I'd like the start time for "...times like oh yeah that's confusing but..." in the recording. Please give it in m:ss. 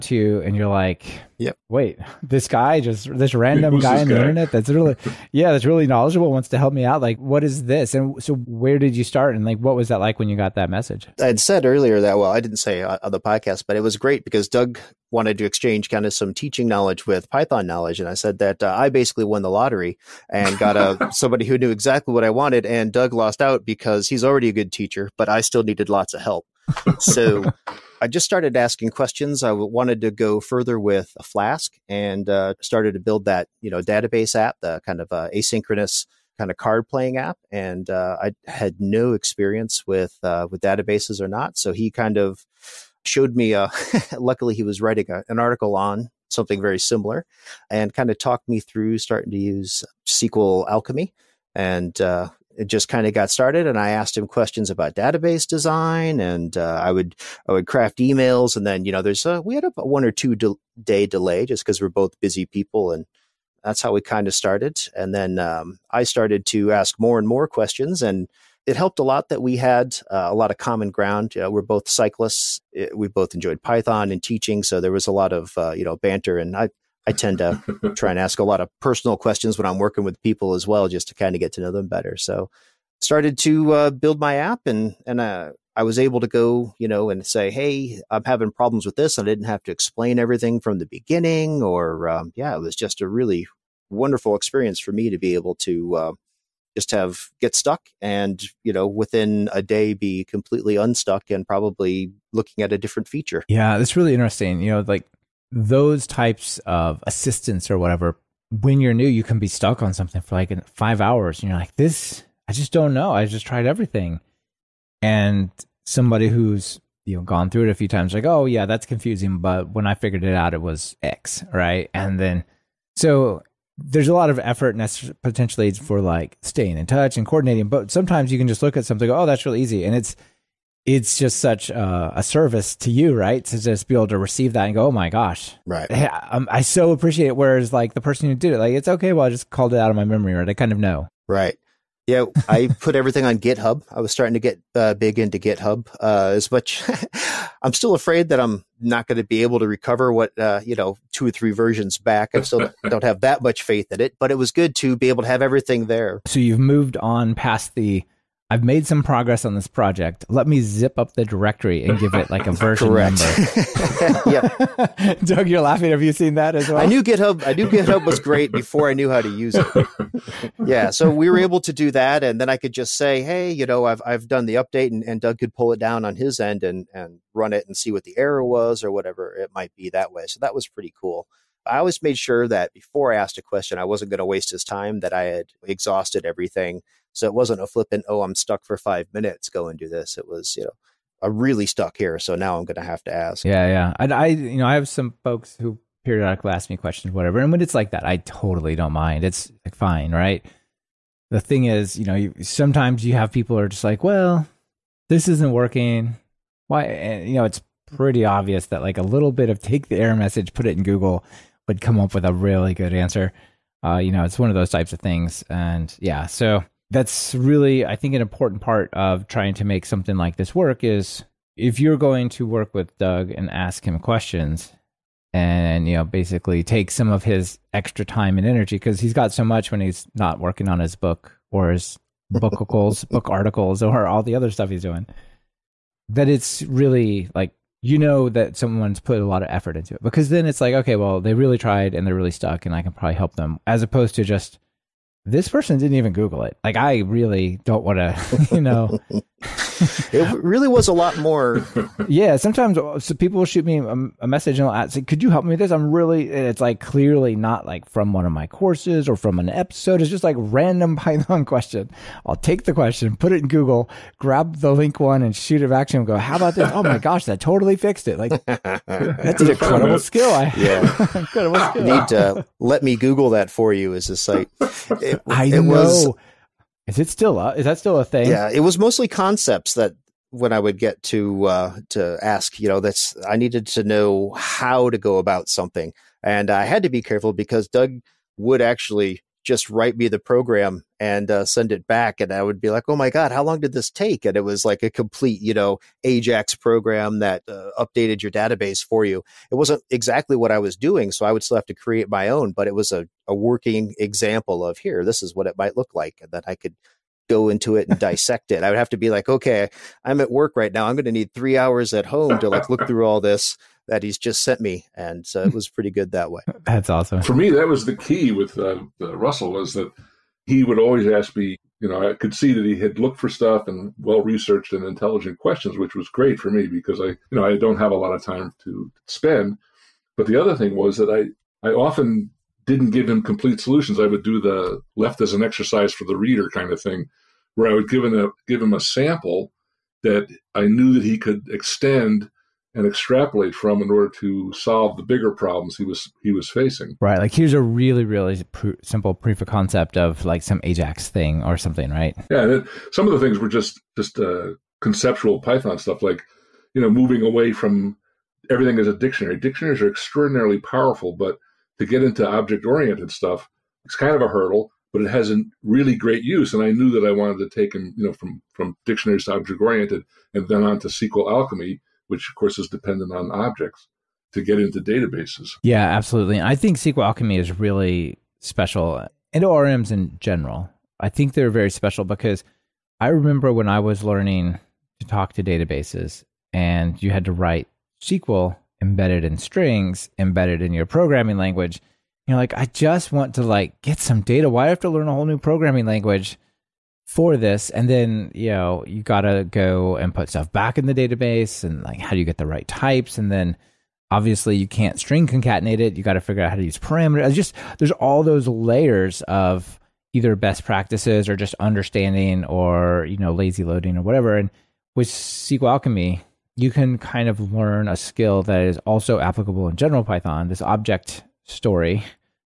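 1:57.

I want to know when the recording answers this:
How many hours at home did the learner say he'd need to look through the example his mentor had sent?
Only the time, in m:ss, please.
5:11.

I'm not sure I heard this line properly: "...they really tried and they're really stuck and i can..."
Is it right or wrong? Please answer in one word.
right.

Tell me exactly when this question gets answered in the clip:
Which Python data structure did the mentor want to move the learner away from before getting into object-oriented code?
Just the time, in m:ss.
5:58.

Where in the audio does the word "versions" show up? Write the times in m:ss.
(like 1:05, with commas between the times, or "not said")
2:31, 2:42.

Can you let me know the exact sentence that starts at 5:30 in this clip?
But the other thing was that I, I often didn't give him complete solutions.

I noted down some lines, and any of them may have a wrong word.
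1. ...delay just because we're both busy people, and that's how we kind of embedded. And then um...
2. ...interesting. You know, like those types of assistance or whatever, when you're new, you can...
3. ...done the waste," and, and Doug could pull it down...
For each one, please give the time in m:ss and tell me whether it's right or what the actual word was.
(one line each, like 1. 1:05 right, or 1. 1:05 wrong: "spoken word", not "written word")
1. 1:01 wrong: "started", not "embedded"
2. 1:44 right
3. 2:54 wrong: "update", not "waste".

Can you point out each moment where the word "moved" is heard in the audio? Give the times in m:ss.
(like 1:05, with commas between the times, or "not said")
2:36.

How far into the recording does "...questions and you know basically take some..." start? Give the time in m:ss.
3:43.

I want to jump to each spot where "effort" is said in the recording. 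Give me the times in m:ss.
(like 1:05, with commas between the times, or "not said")
2:04, 3:59.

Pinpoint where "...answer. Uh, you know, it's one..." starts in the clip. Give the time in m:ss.
3:32.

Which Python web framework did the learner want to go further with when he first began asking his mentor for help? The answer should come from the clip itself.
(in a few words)
Flask.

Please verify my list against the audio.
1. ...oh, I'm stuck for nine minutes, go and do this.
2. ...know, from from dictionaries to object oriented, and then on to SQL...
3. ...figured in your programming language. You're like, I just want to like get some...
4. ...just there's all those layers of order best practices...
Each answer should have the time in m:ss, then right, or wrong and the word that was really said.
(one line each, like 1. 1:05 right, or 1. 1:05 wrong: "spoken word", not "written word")
1. 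3:08 wrong: "five", not "nine"
2. 6:08 right
3. 6:30 wrong: "embedded", not "figured"
4. 6:47 wrong: "either", not "order".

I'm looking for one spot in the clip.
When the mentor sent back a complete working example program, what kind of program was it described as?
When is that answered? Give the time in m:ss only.
4:56.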